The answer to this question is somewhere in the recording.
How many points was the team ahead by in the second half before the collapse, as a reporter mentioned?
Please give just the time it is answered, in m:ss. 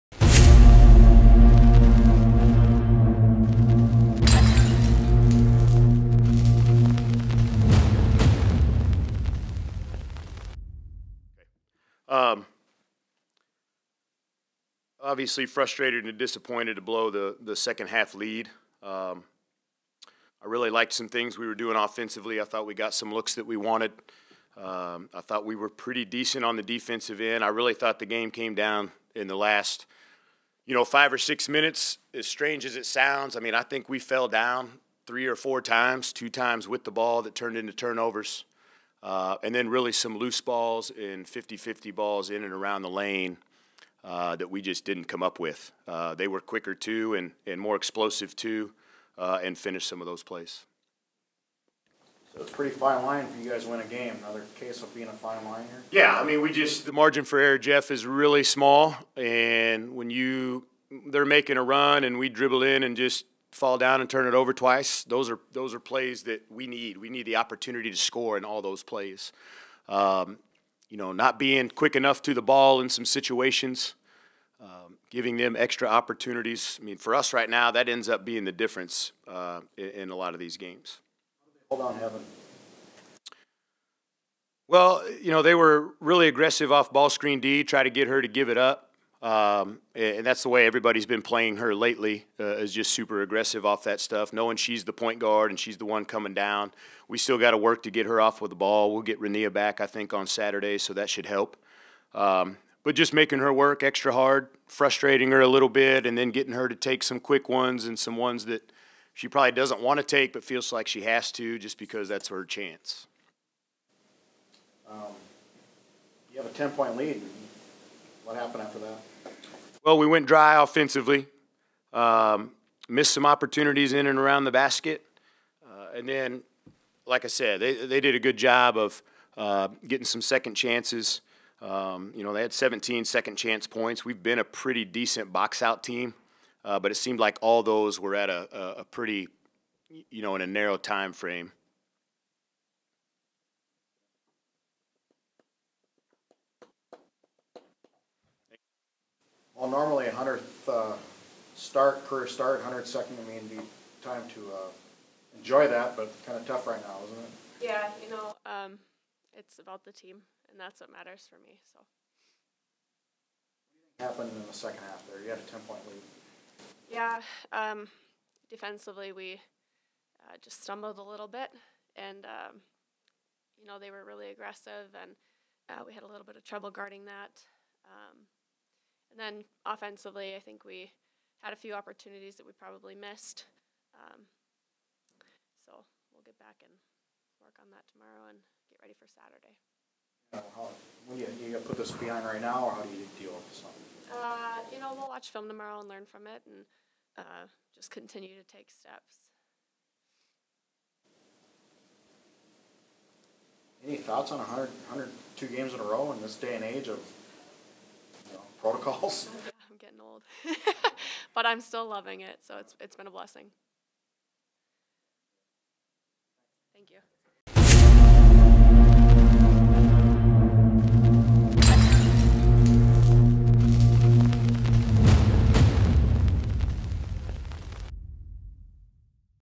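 1:56.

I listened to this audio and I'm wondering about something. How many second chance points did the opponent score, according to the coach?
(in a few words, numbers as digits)
17.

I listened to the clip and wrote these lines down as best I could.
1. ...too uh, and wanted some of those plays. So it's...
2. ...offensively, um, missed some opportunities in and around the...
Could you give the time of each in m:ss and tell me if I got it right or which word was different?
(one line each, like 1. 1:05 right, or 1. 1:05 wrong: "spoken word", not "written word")
1. 0:48 wrong: "finished", not "wanted"
2. 2:00 right.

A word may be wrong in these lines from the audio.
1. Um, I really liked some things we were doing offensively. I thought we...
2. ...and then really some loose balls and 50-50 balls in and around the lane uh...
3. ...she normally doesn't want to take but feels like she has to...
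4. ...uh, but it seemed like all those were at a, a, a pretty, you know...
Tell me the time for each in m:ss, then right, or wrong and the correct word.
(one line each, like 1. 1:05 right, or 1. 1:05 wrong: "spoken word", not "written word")
1. 0:18 right
2. 0:39 right
3. 1:49 wrong: "probably", not "normally"
4. 2:16 right.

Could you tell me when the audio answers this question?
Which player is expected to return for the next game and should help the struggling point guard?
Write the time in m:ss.
1:39.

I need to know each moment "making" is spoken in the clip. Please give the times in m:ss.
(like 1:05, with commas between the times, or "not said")
1:01, 1:43.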